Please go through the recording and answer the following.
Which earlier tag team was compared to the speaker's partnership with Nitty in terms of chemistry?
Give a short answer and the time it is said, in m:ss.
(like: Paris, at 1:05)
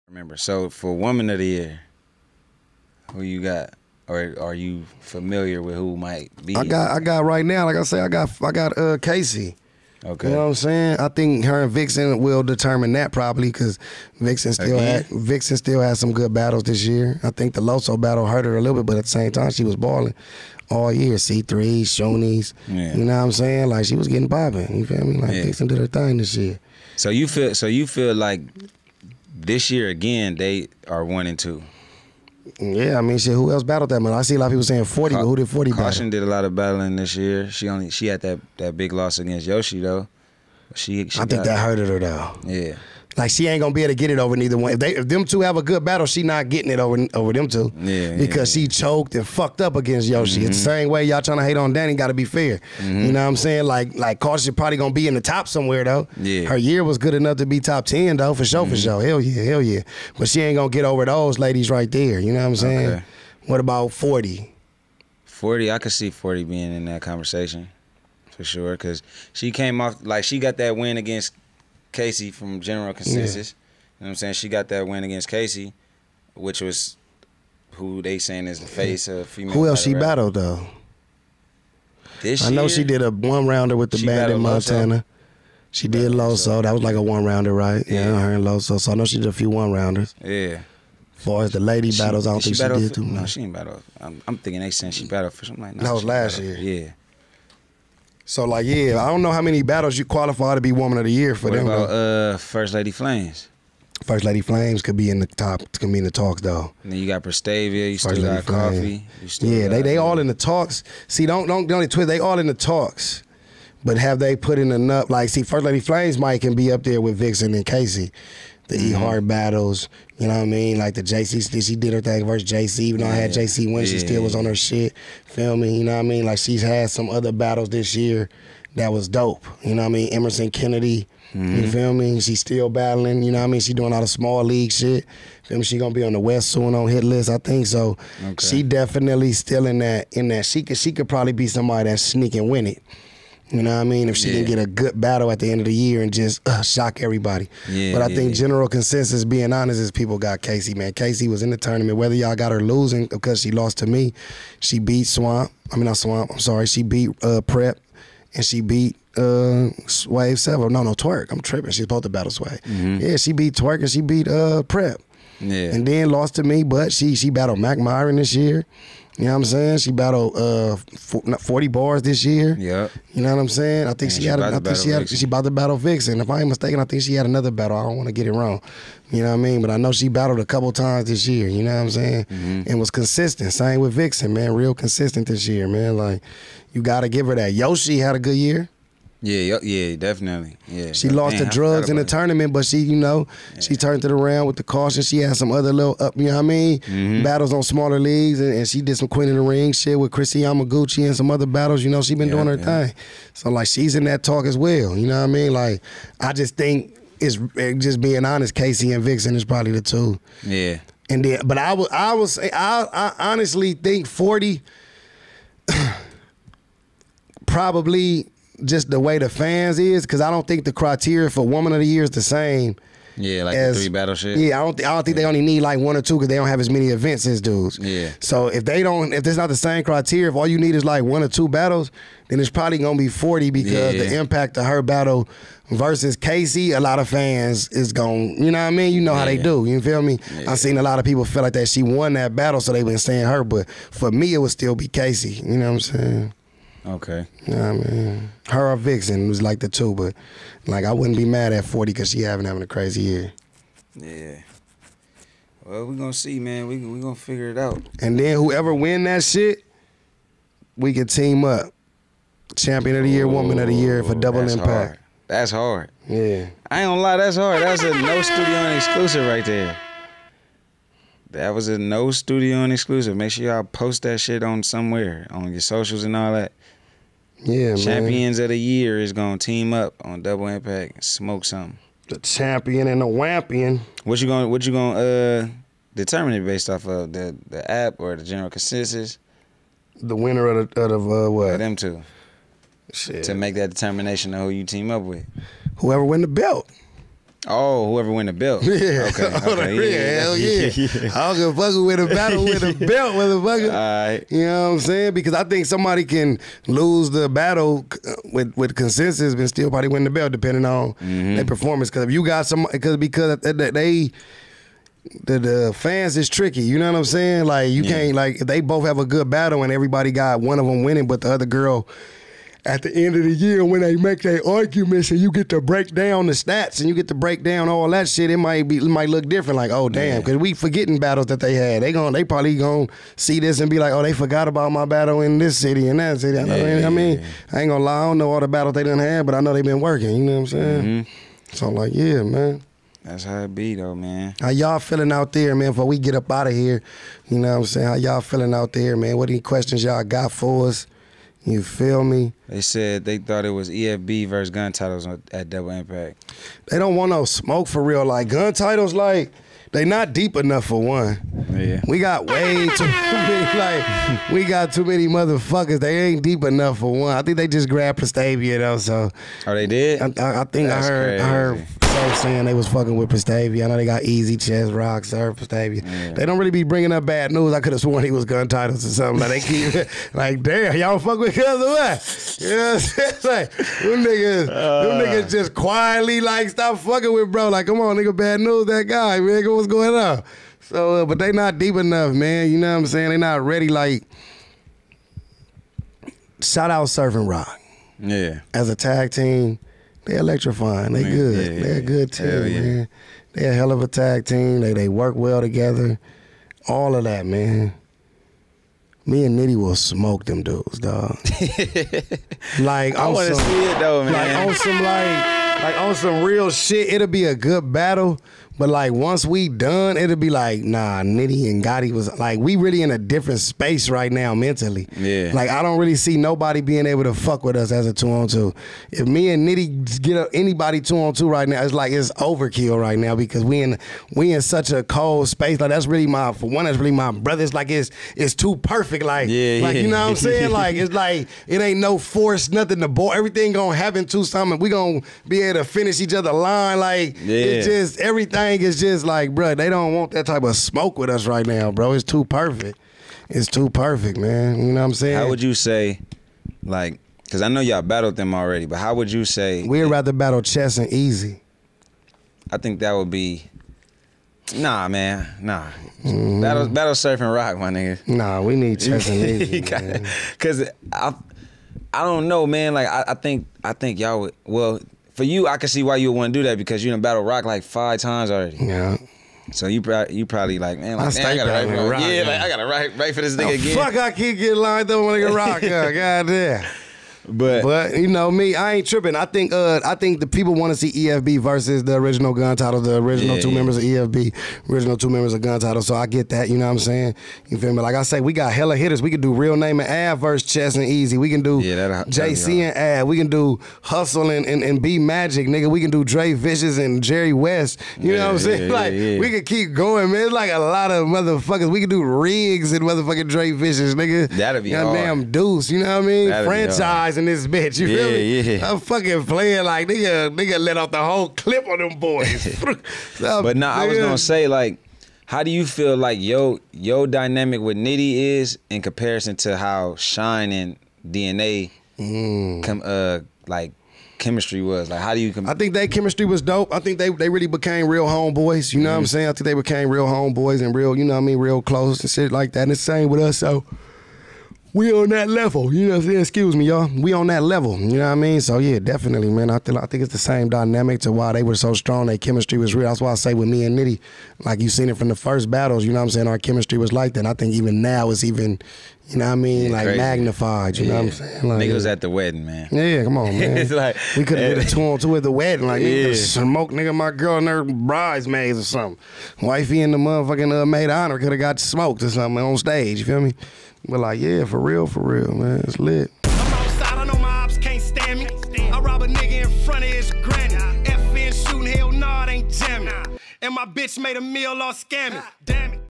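Shine and DNA, at 8:49.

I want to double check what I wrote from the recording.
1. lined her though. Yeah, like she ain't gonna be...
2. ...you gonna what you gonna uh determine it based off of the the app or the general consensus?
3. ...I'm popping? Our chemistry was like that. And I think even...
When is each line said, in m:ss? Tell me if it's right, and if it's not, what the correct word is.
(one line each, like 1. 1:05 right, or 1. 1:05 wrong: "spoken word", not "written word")
1. 0:41 wrong: "hurted", not "lined"
2. 4:44 right
3. 9:16 wrong: "saying", not "popping".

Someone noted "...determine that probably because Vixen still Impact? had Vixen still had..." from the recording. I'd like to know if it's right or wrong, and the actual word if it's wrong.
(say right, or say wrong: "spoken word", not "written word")
wrong: "Again", not "Impact".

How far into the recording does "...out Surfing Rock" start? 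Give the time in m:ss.
6:36.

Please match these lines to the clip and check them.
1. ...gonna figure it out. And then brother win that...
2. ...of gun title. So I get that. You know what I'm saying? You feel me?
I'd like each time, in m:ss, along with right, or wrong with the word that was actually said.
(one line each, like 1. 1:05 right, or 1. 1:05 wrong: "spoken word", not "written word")
1. 4:16 wrong: "whoever", not "brother"
2. 8:15 right.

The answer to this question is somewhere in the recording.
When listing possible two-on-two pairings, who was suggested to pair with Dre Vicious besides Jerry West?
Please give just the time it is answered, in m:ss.
8:32.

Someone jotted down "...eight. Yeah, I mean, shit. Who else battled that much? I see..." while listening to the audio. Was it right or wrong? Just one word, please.
wrong.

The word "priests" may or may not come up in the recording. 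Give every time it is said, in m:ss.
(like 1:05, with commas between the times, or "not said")
not said.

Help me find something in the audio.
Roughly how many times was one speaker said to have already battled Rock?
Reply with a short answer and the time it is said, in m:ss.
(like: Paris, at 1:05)
5, at 7:57.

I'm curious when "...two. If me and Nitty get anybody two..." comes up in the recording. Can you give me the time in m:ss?
7:08.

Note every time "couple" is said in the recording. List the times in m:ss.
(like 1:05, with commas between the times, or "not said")
3:00.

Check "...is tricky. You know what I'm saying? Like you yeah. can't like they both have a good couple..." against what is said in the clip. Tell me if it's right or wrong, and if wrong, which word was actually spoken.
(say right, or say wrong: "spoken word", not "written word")
wrong: "battle", not "couple".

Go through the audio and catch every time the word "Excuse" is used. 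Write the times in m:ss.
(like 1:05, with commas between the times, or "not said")
9:06.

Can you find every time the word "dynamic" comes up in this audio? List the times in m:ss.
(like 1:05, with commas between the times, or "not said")
8:47, 9:10.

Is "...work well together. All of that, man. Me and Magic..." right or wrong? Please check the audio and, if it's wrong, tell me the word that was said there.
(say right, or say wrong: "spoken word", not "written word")
wrong: "Nitty", not "Magic".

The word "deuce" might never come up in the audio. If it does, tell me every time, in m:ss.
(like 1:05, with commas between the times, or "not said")
8:35.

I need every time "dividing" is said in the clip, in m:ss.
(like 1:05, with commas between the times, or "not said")
not said.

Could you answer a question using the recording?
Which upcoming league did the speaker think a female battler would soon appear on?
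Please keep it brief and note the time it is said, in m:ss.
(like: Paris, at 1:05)
Hit List, at 2:16.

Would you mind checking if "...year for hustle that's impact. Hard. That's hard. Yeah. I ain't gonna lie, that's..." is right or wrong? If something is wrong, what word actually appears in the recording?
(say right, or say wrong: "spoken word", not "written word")
wrong: "double", not "hustle".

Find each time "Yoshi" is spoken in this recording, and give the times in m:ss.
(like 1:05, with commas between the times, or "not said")
0:39, 0:50, 3:07.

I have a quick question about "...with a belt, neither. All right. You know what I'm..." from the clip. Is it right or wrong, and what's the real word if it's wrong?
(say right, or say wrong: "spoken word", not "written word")
wrong: "motherfucker", not "neither".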